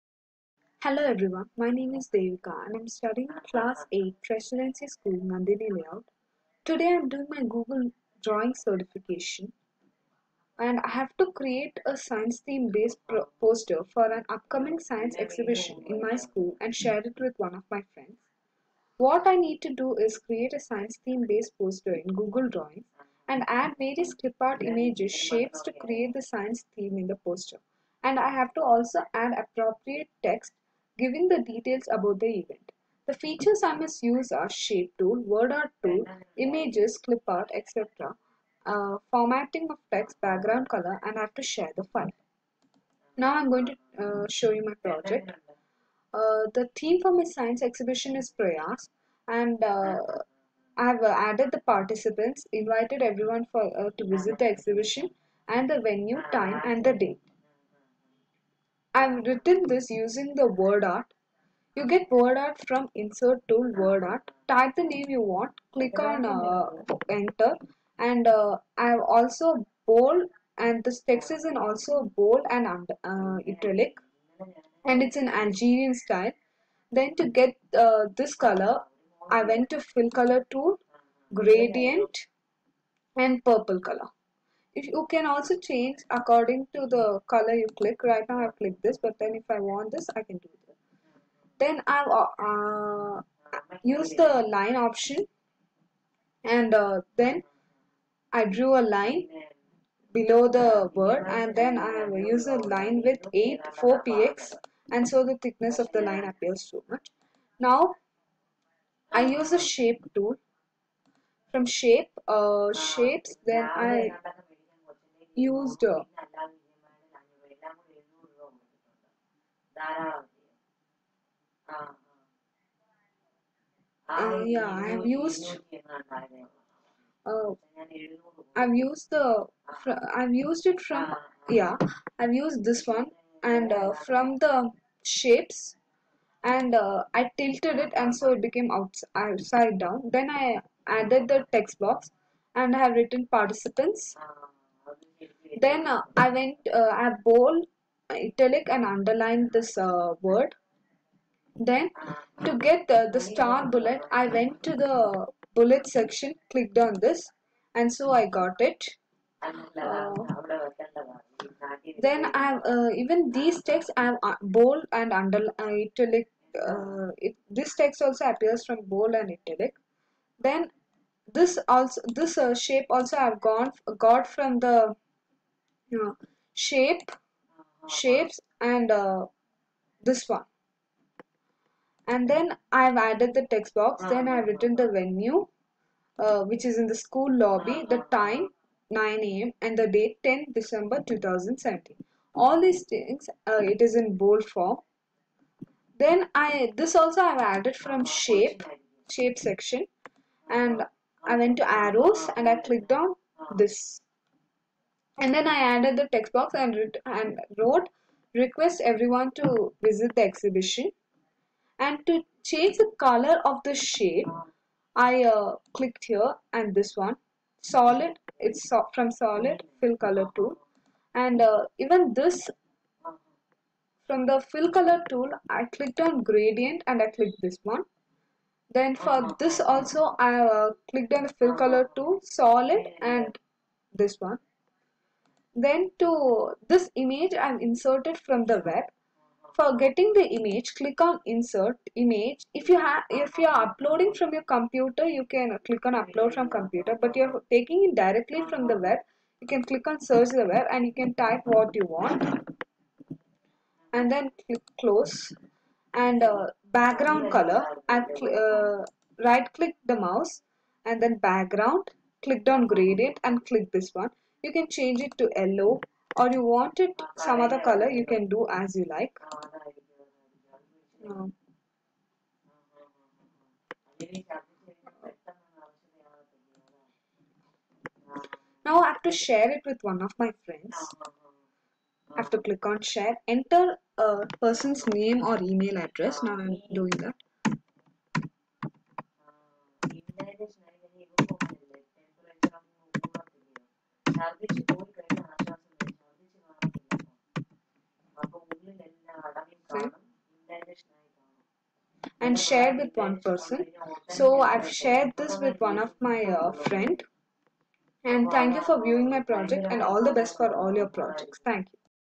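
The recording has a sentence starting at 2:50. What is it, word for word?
Then this also this uh, shape also I've gone got from the no, shape uh-huh.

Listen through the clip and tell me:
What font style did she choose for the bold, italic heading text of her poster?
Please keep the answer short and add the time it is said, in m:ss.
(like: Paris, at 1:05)
Algerian, at 1:15.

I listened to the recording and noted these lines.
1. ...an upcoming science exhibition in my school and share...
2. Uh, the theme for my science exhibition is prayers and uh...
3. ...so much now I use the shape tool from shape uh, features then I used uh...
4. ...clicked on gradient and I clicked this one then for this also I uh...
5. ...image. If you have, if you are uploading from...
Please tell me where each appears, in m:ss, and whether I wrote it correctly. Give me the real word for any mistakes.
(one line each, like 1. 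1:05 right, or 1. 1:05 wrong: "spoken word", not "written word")
1. 0:14 right
2. 0:46 right
3. 1:46 wrong: "shapes", not "features"
4. 3:45 right
5. 4:01 right.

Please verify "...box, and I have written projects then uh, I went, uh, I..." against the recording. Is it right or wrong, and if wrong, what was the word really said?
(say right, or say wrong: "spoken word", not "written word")
wrong: "participants", not "projects".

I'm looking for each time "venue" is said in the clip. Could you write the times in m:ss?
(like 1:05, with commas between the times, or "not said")
0:55, 3:04.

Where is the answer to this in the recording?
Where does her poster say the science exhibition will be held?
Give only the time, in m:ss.
3:06.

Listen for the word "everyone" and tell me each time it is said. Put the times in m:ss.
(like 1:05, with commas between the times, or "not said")
0:01, 0:53, 3:28.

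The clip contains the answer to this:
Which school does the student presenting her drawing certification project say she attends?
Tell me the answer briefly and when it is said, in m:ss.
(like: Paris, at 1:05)
Presidency School, at 0:04.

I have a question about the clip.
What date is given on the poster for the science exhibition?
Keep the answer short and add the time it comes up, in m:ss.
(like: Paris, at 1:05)
10 December 2017, at 3:10.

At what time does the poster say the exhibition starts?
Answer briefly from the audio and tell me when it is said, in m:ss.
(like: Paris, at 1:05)
9 a.m., at 3:08.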